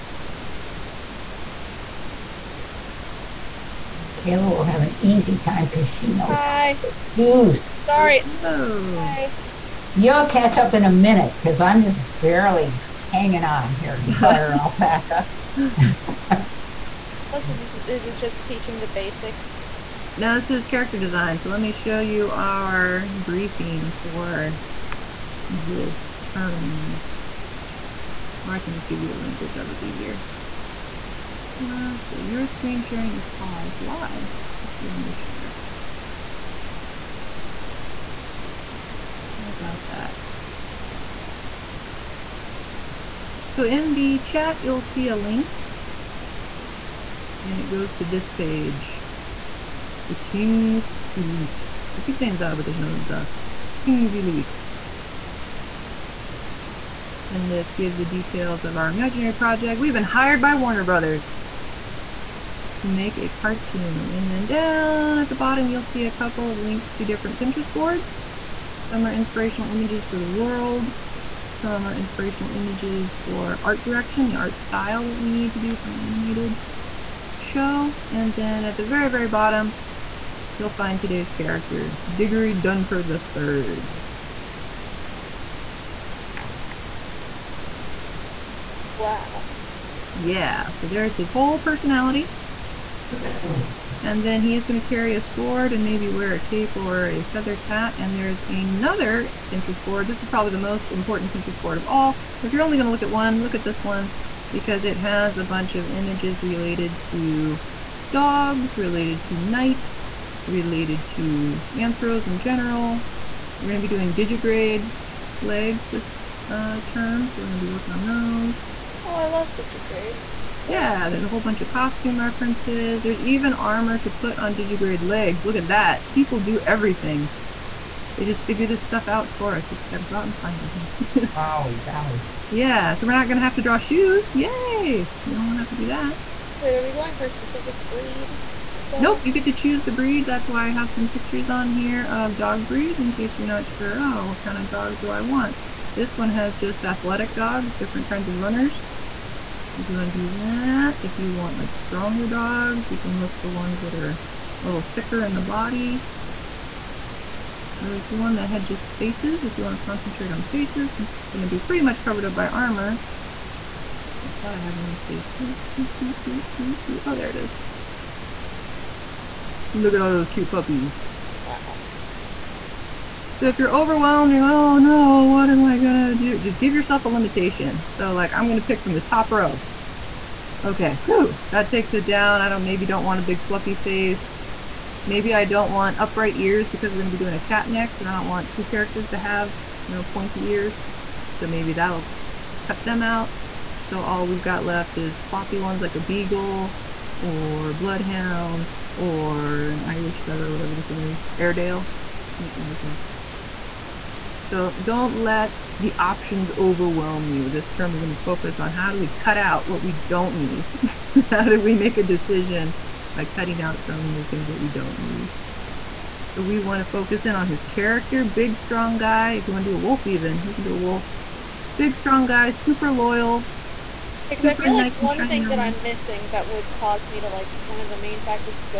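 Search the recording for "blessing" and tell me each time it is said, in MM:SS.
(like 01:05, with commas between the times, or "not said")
not said.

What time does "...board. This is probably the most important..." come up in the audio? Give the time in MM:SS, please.
01:39.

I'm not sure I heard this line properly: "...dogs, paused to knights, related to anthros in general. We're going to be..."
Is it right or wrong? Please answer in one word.
wrong.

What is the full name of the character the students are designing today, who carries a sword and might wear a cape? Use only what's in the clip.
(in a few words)
Diggory Dunford III.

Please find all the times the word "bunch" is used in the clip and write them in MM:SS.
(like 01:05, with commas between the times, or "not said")
01:45, 02:01.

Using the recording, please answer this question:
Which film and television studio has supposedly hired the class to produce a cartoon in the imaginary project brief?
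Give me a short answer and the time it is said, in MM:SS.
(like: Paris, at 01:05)
Warner Brothers, at 01:00.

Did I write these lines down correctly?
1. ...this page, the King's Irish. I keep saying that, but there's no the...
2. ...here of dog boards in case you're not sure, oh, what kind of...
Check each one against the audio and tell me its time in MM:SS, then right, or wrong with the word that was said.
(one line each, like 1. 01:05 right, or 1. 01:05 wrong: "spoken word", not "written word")
1. 00:48 wrong: "Elite", not "Irish"
2. 02:21 wrong: "breeds", not "boards".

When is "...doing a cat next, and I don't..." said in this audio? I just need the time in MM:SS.
03:07.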